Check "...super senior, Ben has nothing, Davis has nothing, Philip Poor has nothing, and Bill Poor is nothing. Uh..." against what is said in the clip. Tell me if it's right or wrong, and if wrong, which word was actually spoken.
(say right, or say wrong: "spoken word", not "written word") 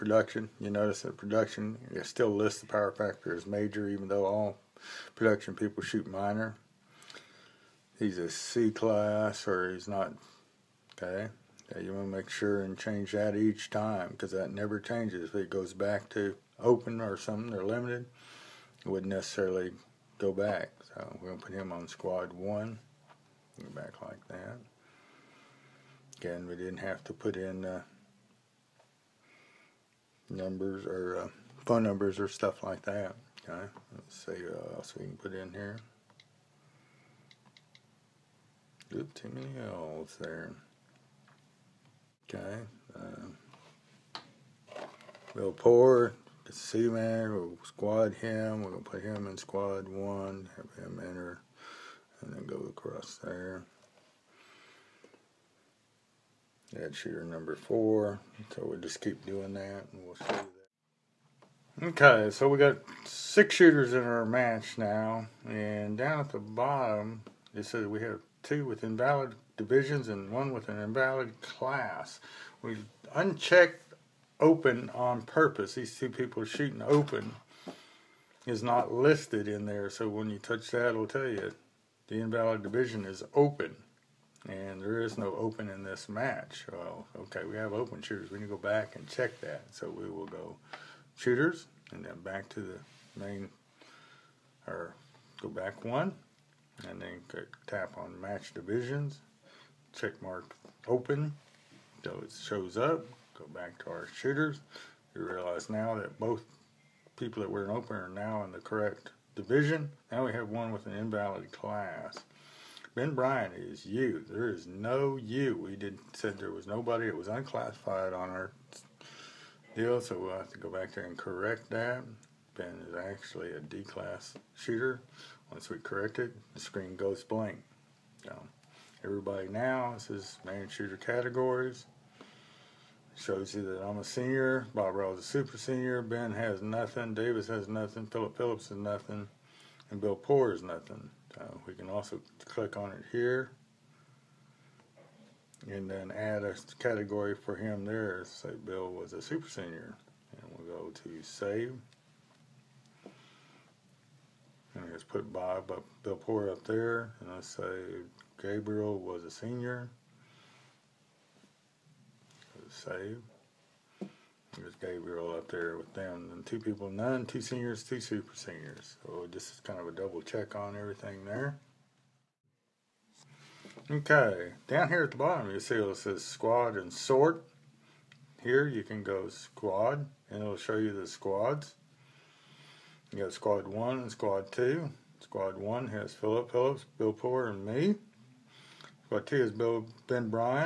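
wrong: "Phillips", not "Poor".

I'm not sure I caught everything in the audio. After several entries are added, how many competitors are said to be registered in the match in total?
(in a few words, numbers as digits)
6.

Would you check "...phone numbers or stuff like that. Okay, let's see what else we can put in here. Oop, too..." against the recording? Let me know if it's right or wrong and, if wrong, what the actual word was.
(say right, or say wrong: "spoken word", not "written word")
right.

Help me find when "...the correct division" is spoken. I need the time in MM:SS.
01:48.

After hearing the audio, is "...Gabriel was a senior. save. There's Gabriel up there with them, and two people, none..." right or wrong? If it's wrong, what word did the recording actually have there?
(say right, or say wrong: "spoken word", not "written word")
right.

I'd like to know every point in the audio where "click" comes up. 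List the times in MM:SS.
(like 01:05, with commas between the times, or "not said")
02:22.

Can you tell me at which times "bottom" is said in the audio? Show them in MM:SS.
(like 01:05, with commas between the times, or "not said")
01:06, 02:55.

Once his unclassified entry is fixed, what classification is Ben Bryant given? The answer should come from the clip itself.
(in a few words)
D-class.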